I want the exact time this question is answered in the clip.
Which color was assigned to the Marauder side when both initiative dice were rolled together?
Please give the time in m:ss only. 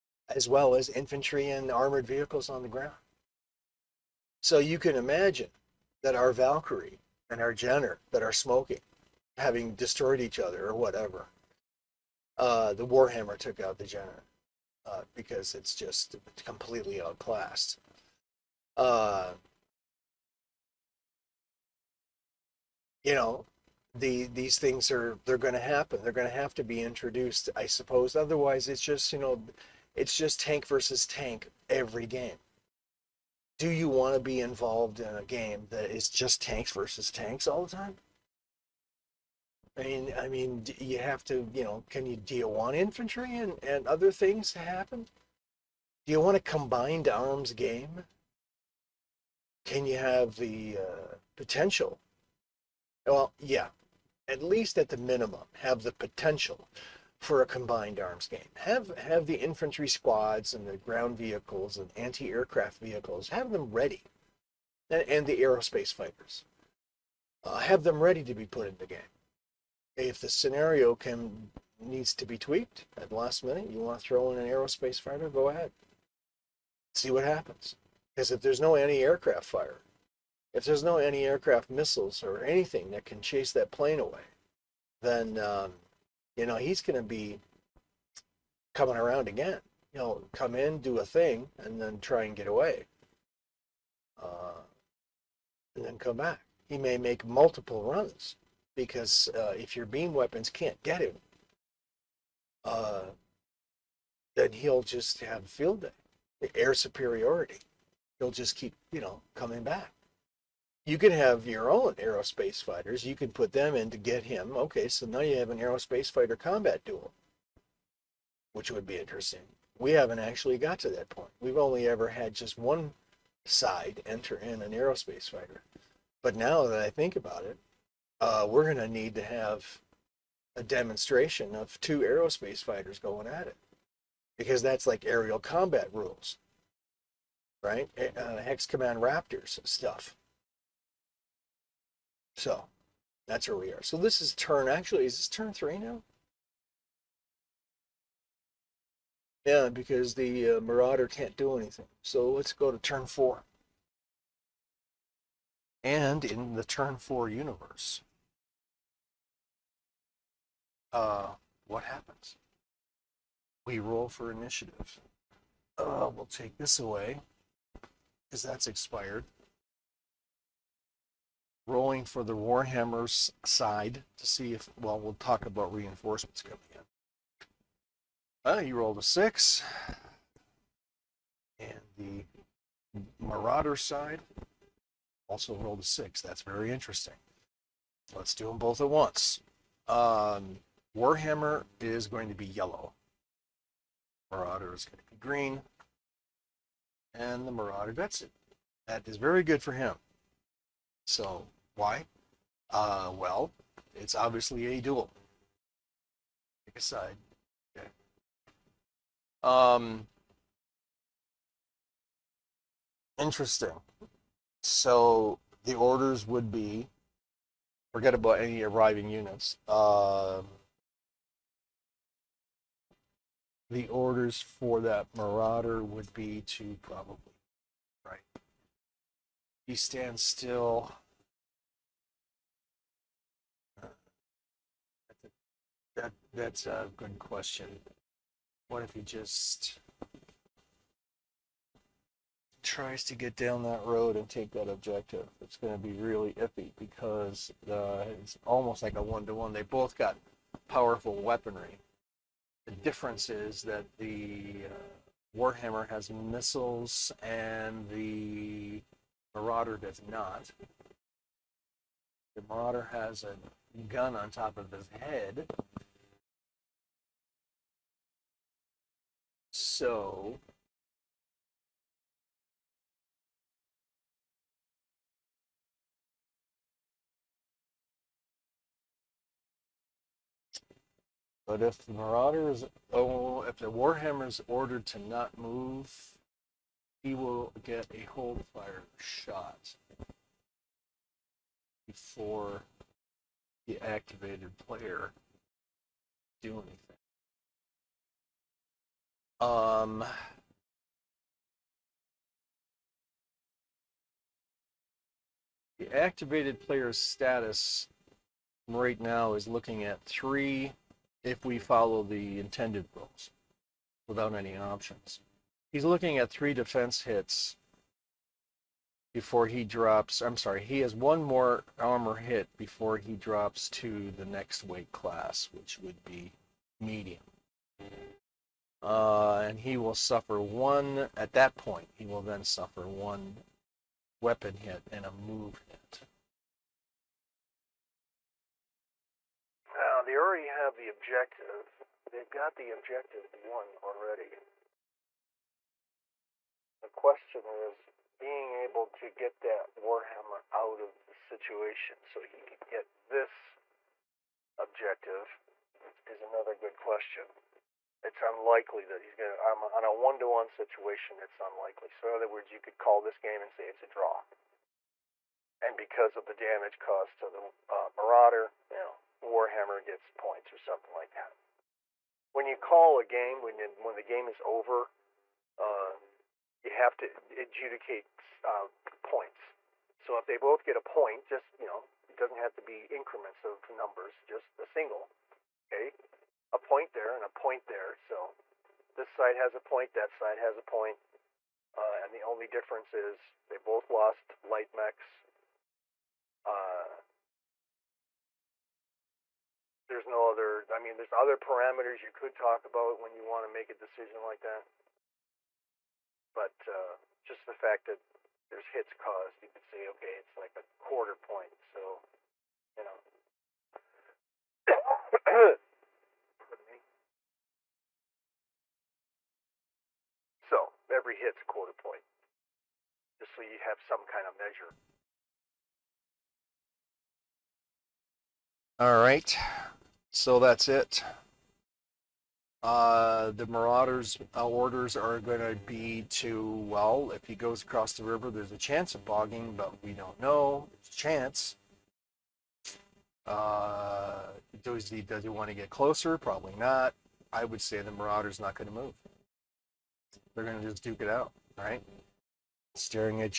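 3:14.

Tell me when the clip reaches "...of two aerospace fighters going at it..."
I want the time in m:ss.
2:11.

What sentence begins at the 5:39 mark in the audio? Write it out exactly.
Now, they already have the objective.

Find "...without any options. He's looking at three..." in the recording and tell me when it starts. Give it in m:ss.
5:14.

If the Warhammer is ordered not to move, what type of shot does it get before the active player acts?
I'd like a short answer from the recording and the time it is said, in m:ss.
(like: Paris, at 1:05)
Hold fire shot, at 4:48.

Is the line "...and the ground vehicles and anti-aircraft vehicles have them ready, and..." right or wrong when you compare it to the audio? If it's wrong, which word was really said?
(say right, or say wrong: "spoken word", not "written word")
right.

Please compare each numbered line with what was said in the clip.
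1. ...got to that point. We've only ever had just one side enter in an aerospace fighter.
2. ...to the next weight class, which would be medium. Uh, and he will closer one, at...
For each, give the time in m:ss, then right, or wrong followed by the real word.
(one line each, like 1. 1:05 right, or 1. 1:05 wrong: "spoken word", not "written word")
1. 2:00 right
2. 5:23 wrong: "suffer", not "closer".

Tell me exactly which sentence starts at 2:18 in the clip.
Uh, Hex Command Raptors stuff so that's where we are.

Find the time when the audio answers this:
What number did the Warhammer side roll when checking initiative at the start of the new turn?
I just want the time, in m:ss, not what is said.
2:58.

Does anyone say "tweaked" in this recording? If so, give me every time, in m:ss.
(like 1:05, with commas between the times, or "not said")
1:12.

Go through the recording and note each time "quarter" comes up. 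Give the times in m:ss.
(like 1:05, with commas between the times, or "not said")
6:50, 7:01.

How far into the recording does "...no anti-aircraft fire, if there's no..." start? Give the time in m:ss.
1:18.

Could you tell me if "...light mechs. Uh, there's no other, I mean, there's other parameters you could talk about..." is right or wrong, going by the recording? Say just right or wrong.
right.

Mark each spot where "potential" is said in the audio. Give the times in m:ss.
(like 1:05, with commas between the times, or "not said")
0:51, 0:55.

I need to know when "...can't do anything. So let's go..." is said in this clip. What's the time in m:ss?
2:31.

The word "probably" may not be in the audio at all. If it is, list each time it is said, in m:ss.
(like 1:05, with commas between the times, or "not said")
3:46, 7:26.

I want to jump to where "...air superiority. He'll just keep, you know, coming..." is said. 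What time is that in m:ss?
1:46.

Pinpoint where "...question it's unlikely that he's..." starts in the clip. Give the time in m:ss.
5:56.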